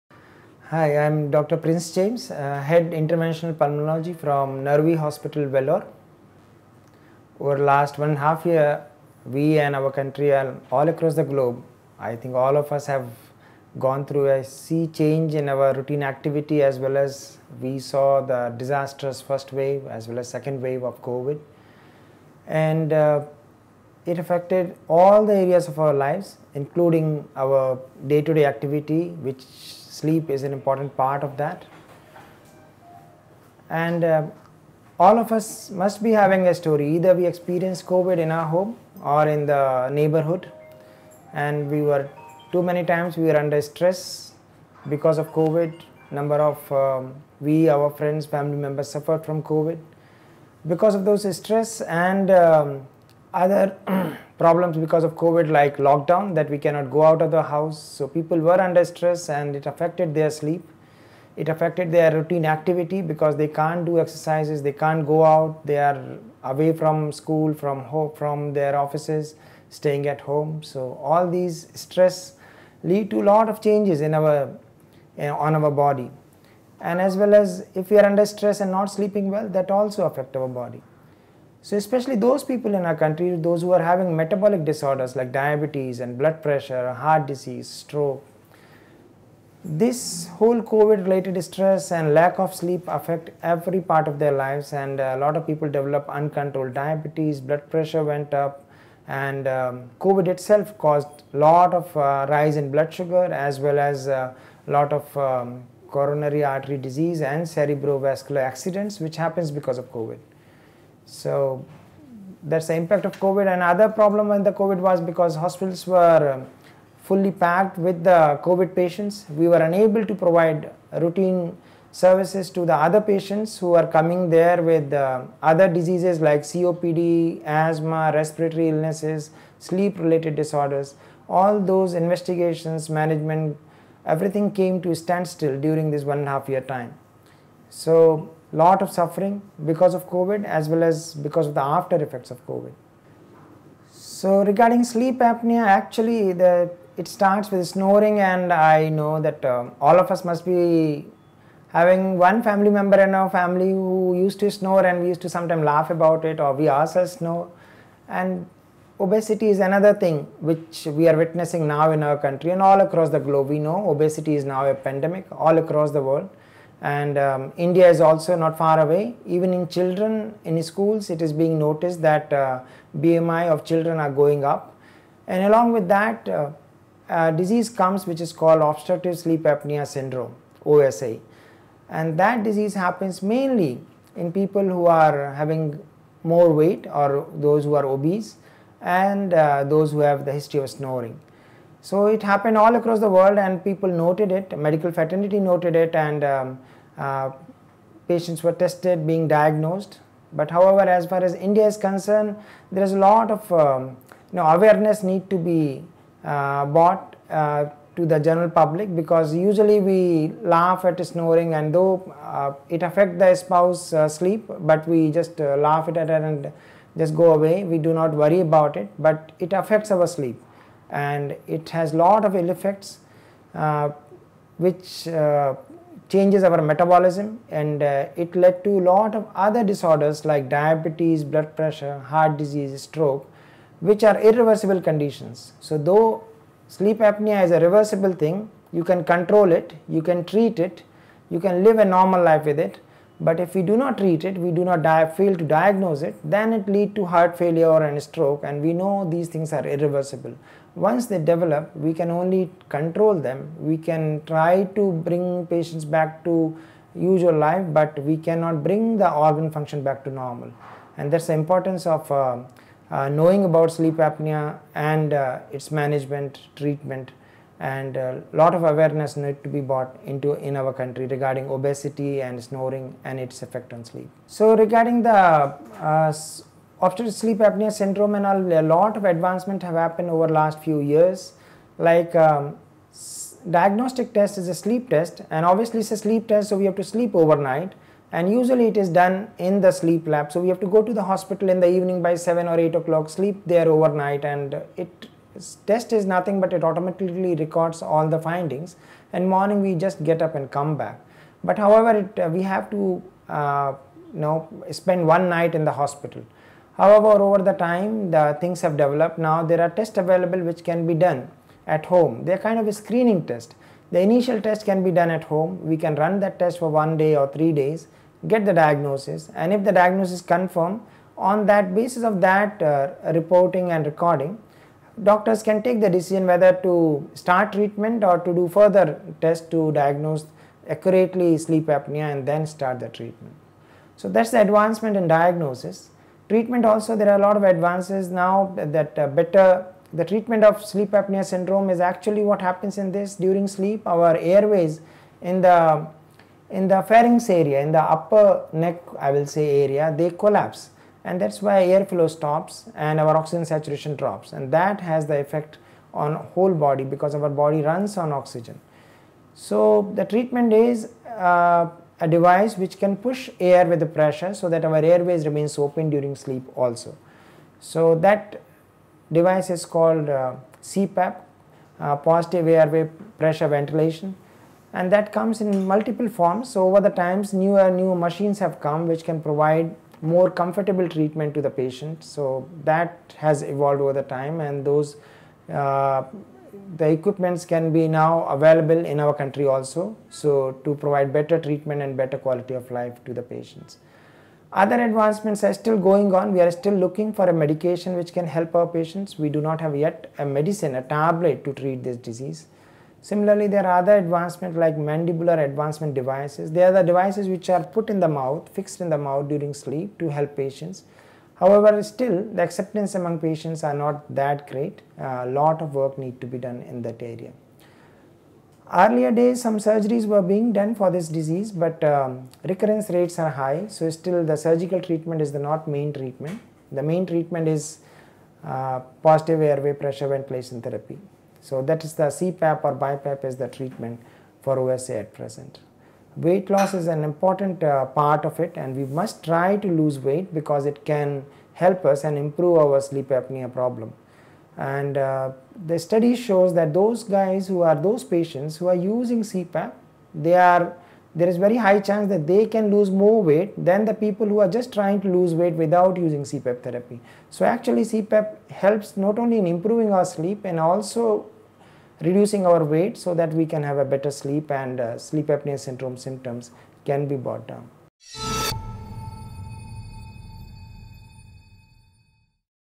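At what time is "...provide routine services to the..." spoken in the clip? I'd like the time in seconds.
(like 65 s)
120 s.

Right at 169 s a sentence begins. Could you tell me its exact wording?
Even in children in schools, it is being noticed that uh, BMI of children are going up.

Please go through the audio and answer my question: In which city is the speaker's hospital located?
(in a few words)
Vellore.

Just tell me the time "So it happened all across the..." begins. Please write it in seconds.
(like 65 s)
191 s.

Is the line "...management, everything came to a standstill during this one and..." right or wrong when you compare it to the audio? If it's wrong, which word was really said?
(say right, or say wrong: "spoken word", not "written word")
right.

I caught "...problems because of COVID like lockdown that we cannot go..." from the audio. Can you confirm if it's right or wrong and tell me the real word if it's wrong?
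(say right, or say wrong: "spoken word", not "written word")
right.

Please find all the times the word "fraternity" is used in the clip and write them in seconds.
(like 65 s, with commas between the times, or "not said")
194 s.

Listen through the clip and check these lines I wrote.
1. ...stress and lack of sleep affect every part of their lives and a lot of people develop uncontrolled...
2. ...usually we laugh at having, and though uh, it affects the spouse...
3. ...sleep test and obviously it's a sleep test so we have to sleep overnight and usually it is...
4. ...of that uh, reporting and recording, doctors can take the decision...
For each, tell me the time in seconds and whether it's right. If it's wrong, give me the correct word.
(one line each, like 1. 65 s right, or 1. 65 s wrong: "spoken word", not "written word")
1. 91 s right
2. 209 s wrong: "snoring", not "having"
3. 284 s right
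4. 322 s right.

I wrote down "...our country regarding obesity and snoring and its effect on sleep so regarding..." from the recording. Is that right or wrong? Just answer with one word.
right.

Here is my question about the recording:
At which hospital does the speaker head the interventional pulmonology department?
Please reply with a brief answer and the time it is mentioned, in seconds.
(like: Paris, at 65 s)
Naruvi Hospital, at 4 s.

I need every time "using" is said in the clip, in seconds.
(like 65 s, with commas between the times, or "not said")
448 s, 455 s.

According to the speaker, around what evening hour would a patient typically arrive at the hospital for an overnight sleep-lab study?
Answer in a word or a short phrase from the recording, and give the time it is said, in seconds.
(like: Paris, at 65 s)
7 or 8 o'clock, at 292 s.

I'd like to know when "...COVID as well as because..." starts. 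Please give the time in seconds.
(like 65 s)
140 s.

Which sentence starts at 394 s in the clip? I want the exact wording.
Other advancements are still going on.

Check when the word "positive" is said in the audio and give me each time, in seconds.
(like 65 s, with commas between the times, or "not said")
371 s, 429 s.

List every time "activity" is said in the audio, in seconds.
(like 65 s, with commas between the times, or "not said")
16 s, 28 s, 62 s.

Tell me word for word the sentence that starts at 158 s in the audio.
And obesity is another thing which we are witnessing now in our country and all across the globe.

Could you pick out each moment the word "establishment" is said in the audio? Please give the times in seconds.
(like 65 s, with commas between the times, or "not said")
not said.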